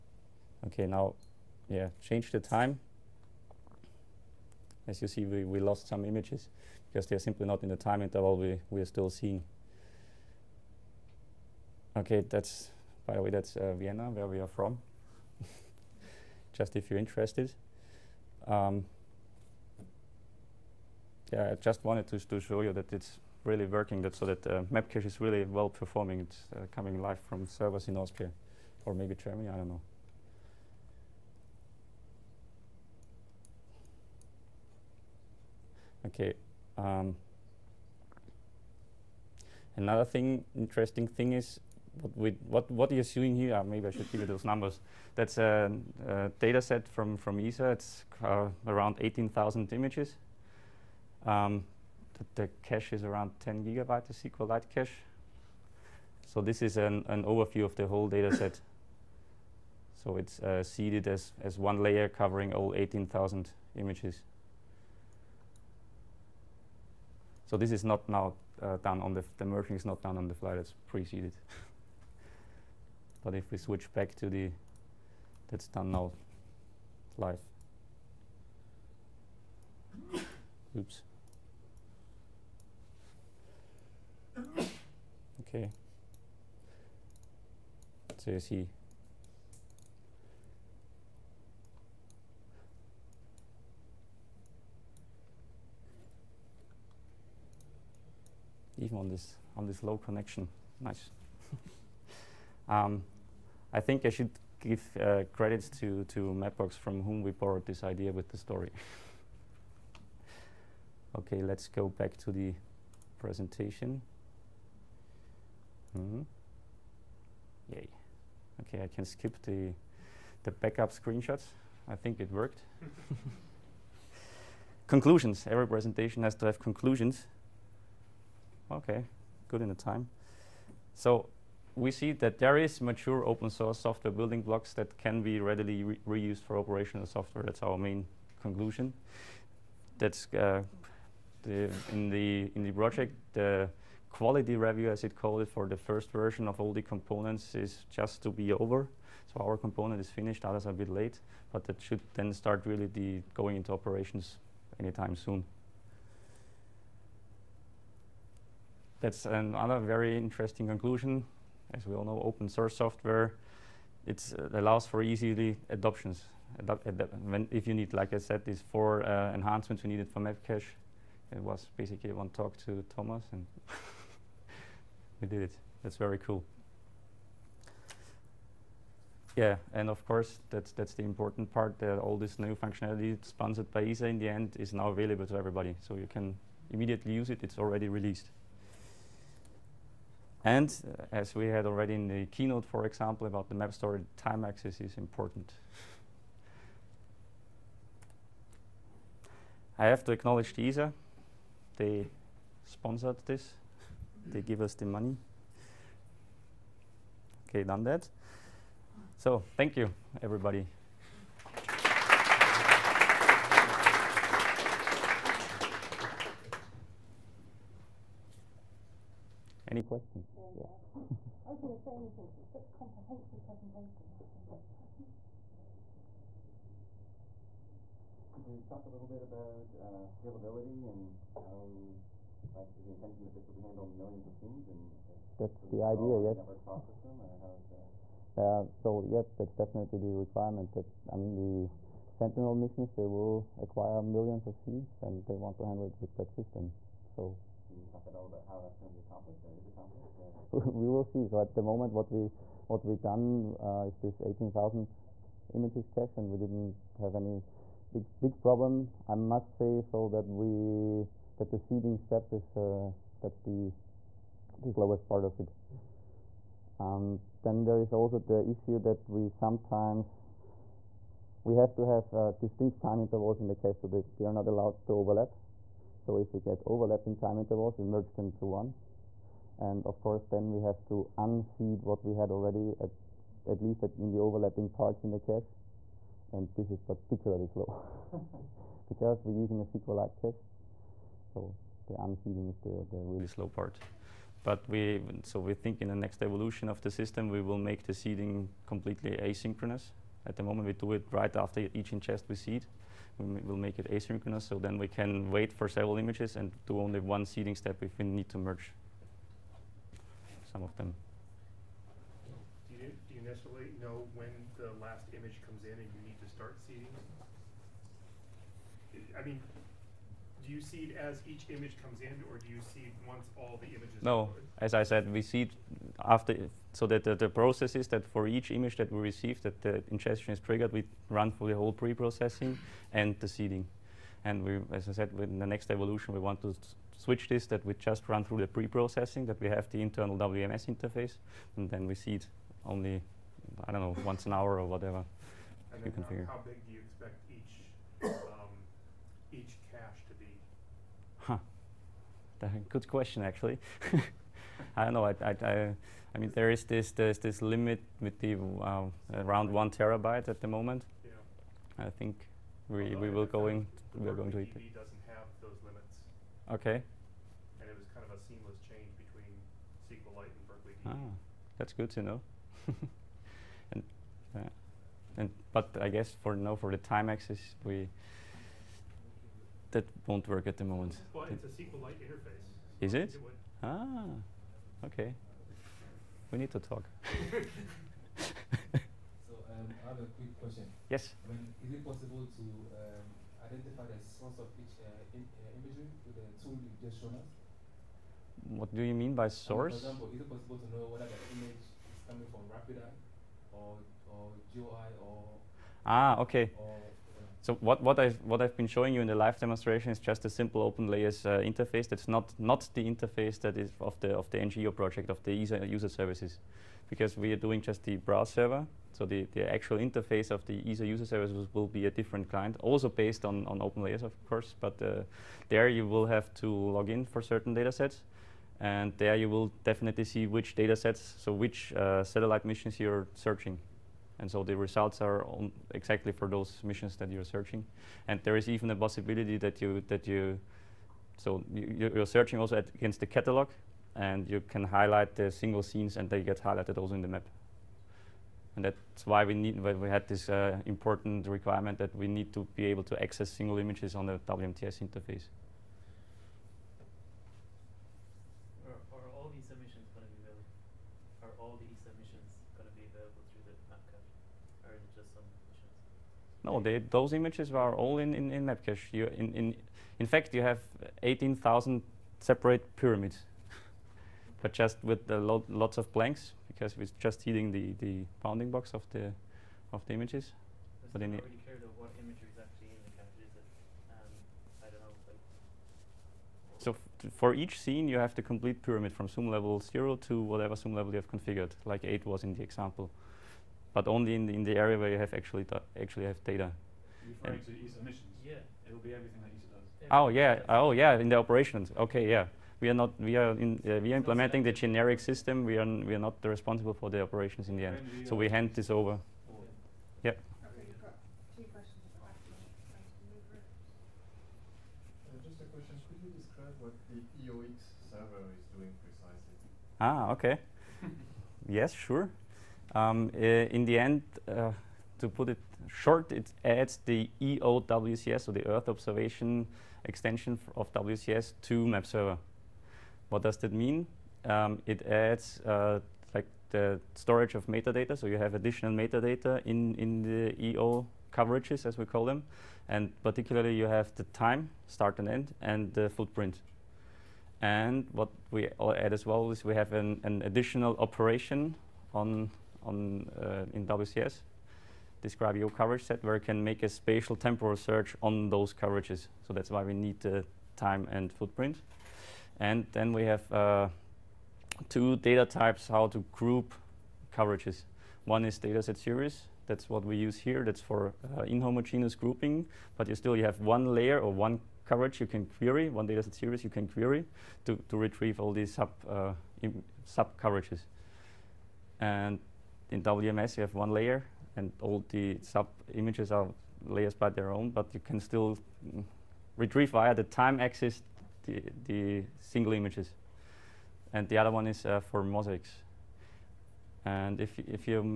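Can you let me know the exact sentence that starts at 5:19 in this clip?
I mean, do you seed as each image comes in, or do you seed once all the images?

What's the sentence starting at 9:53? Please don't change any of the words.
And the other one is uh, for mosaics.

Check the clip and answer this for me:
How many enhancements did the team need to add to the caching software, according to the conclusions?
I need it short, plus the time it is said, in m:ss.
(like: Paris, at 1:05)
four, at 2:48.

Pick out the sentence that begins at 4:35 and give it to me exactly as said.
So if we get overlapping time intervals, we merge them to one.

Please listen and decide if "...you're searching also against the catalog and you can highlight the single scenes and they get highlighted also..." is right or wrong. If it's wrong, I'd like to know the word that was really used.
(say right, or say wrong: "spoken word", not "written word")
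right.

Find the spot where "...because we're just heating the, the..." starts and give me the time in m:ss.
7:56.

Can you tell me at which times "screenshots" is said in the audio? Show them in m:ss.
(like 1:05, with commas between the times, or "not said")
2:00.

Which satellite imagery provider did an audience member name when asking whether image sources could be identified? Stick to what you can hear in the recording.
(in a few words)
RapidEye.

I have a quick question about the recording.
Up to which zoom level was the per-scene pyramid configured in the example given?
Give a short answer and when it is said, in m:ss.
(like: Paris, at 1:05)
eight, at 8:11.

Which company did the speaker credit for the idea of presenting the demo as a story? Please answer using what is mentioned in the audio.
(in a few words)
Mapbox.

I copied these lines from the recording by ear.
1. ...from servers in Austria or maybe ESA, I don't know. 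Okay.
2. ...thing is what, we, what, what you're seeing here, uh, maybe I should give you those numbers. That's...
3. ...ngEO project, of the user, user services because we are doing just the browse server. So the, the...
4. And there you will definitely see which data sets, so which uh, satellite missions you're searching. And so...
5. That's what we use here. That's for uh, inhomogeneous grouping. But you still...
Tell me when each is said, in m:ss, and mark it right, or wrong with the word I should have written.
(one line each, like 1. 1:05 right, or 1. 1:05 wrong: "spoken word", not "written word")
1. 0:27 wrong: "Germany", not "ESA"
2. 0:41 right
3. 6:54 right
4. 7:08 right
5. 9:29 right.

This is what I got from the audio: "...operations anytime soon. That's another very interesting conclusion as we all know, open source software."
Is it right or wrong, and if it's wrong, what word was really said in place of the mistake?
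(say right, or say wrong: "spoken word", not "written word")
right.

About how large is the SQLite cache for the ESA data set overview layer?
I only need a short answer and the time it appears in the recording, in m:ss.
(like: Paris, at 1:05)
10 gigabytes, at 0:53.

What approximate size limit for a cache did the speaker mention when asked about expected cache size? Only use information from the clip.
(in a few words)
one terabyte.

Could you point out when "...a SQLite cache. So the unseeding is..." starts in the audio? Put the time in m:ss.
4:49.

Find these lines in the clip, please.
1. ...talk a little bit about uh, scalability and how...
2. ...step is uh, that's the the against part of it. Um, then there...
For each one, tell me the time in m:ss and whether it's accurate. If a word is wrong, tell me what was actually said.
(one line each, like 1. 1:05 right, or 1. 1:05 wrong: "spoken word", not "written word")
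1. 3:48 right
2. 4:21 wrong: "slowest", not "against".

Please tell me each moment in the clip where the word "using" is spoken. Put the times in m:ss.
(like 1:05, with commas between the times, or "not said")
4:49.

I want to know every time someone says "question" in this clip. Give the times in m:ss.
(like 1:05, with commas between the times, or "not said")
3:39, 5:52, 6:30.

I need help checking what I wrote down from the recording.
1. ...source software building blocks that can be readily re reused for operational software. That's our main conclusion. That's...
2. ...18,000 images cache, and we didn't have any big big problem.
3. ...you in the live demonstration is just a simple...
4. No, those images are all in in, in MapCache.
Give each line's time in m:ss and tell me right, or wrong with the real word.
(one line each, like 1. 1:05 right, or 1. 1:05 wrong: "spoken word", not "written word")
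1. 2:13 right
2. 4:14 right
3. 6:48 right
4. 7:46 right.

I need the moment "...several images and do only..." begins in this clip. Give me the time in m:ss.
5:05.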